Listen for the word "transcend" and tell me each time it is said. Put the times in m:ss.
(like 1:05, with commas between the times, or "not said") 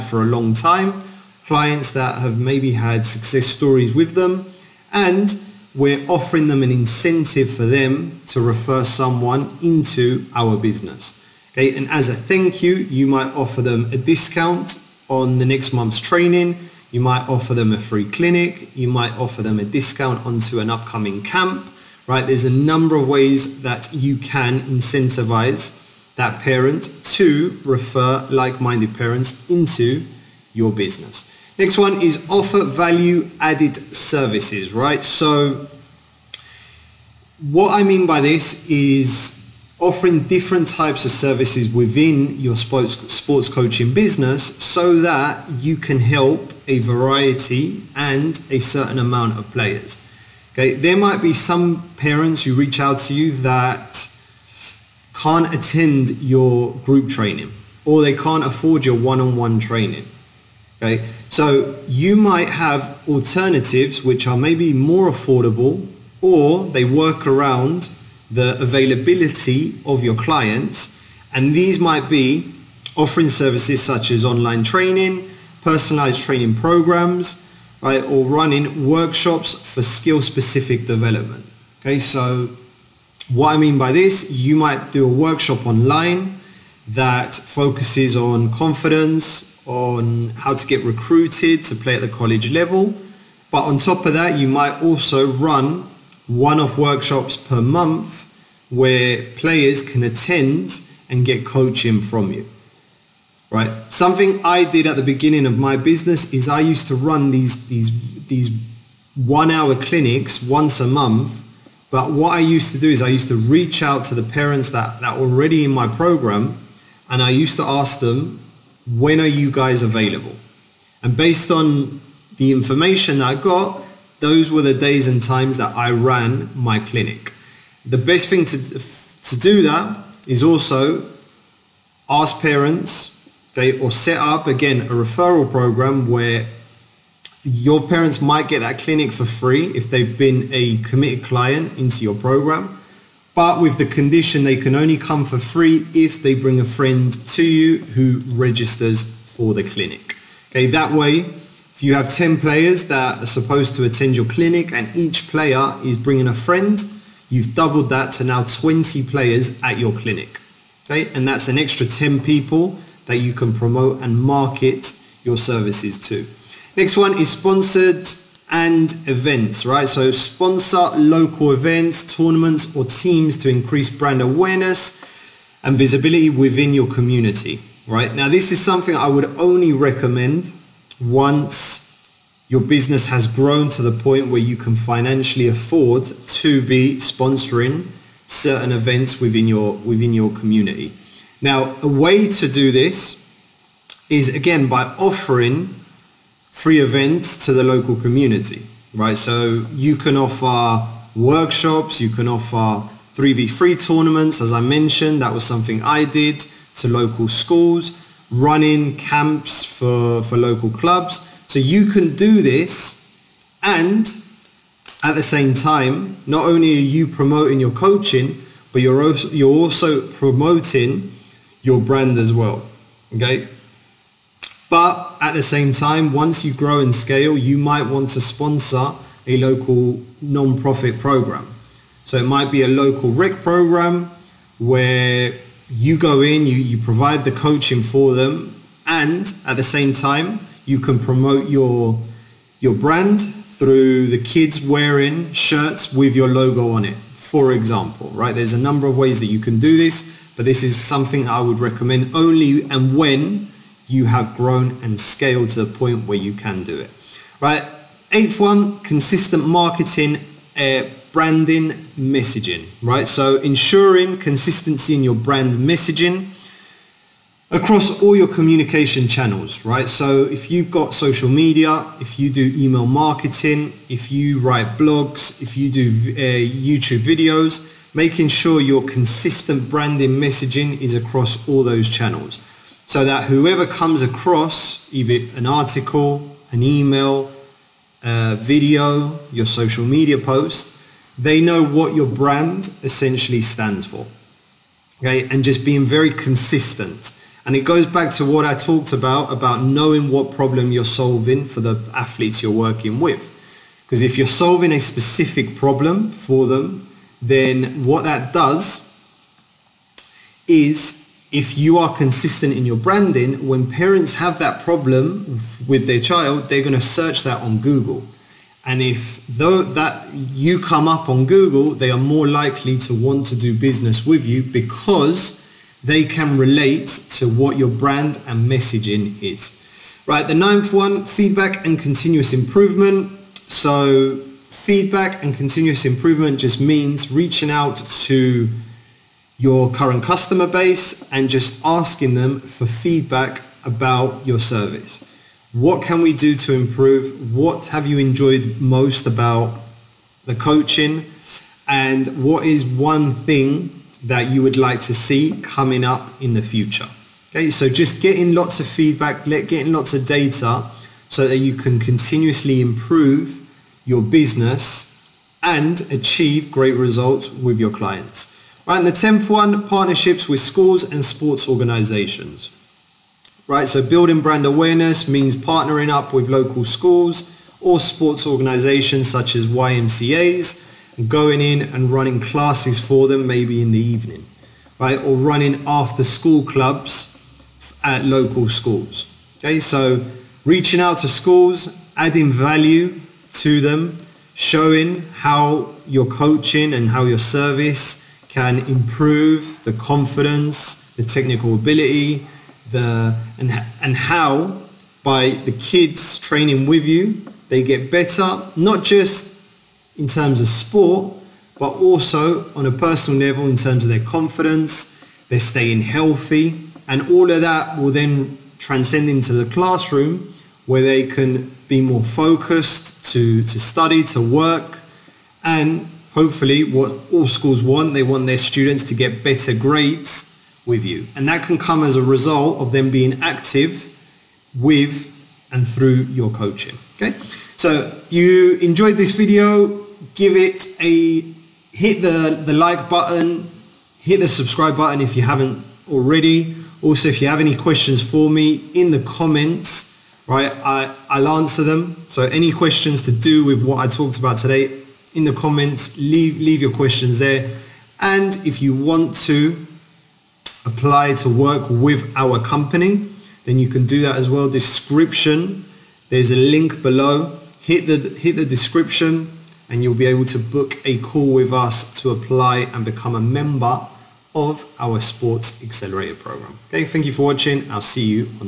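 6:58.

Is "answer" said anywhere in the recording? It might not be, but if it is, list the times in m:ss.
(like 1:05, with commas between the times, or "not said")
7:31.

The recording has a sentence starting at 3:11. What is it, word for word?
Now, a way to do this is again by offering free events to the local community, right?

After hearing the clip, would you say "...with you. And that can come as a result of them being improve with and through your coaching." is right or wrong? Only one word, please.
wrong.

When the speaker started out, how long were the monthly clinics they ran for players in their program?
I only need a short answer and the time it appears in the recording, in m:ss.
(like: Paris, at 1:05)
1 hour, at 1:49.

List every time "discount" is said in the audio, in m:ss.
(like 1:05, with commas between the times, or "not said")
0:13, 0:19.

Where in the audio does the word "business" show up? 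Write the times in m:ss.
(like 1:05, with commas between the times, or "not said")
0:10, 0:30, 0:43, 1:45, 3:02, 5:23, 6:04.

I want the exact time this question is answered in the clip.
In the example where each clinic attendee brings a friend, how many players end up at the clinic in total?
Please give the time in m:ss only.
2:38.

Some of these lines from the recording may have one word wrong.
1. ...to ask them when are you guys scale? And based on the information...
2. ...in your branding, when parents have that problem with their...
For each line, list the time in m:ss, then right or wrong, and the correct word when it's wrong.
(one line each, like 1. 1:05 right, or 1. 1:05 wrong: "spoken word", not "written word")
1. 1:57 wrong: "available", not "scale"
2. 5:12 right.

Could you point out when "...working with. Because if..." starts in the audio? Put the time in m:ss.
5:02.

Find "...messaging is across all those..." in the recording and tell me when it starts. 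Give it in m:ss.
4:40.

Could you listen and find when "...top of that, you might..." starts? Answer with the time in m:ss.
1:33.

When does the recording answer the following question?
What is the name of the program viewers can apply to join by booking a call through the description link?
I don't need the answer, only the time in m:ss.
7:55.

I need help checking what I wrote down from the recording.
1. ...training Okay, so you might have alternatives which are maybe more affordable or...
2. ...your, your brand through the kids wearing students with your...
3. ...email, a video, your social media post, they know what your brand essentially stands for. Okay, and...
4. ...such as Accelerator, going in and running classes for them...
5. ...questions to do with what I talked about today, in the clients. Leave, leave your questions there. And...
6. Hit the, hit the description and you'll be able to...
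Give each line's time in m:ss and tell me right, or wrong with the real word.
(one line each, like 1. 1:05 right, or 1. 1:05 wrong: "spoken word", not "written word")
1. 0:59 right
2. 4:01 wrong: "shirts", not "students"
3. 4:46 right
4. 6:19 wrong: "YMCAs", not "Accelerator"
5. 7:32 wrong: "comments", not "clients"
6. 7:47 right.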